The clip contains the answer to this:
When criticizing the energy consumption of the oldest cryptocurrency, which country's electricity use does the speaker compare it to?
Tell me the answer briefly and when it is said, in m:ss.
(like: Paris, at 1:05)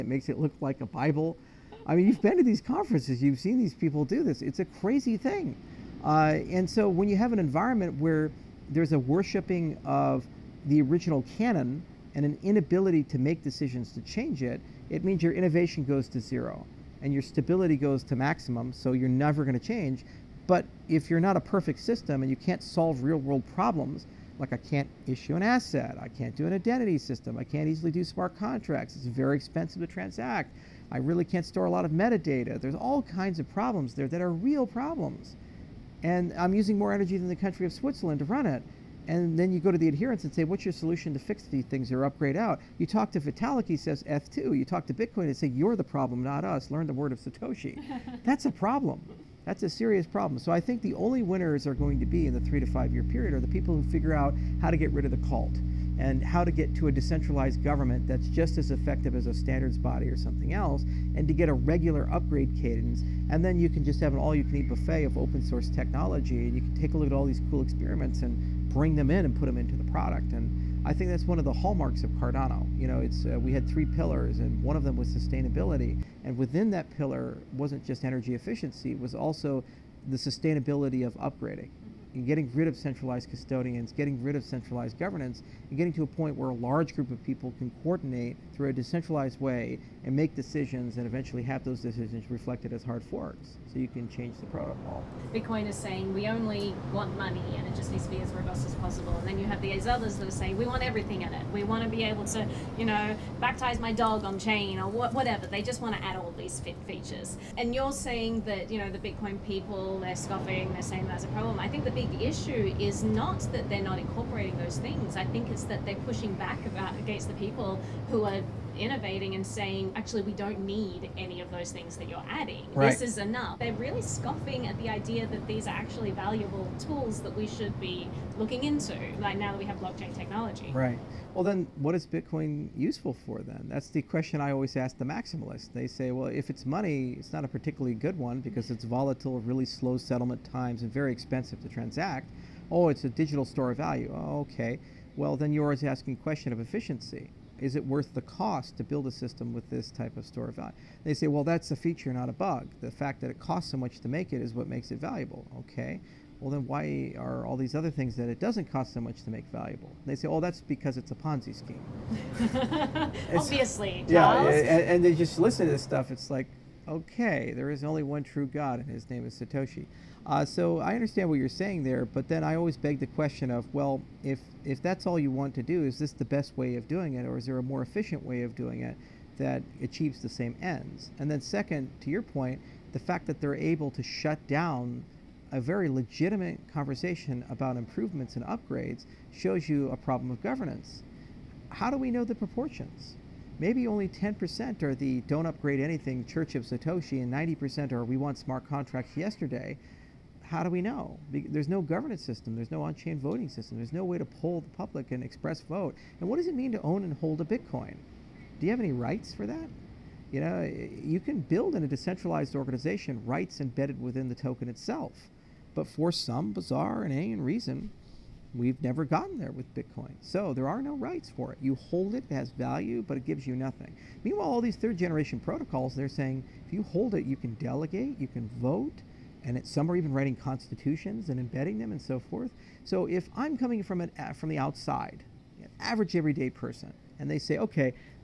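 Switzerland, at 0:37.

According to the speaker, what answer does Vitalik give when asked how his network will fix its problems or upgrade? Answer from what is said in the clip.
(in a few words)
ETH2.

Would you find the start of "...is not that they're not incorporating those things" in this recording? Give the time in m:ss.
1:52.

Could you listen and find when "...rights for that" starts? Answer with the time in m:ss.
3:28.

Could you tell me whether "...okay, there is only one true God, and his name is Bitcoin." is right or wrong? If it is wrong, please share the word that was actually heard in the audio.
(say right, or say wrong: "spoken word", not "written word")
wrong: "Satoshi", not "Bitcoin".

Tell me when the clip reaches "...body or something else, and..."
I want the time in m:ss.
0:59.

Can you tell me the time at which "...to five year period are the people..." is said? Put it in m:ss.
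0:52.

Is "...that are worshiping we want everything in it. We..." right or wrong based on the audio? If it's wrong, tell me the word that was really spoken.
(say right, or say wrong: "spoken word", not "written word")
wrong: "saying", not "worshiping".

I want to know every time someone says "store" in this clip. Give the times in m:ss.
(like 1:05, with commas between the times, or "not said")
0:31, 2:23, 2:30.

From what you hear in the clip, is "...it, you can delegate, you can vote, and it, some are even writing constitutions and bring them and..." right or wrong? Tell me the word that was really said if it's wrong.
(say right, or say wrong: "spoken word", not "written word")
wrong: "embedding", not "bring".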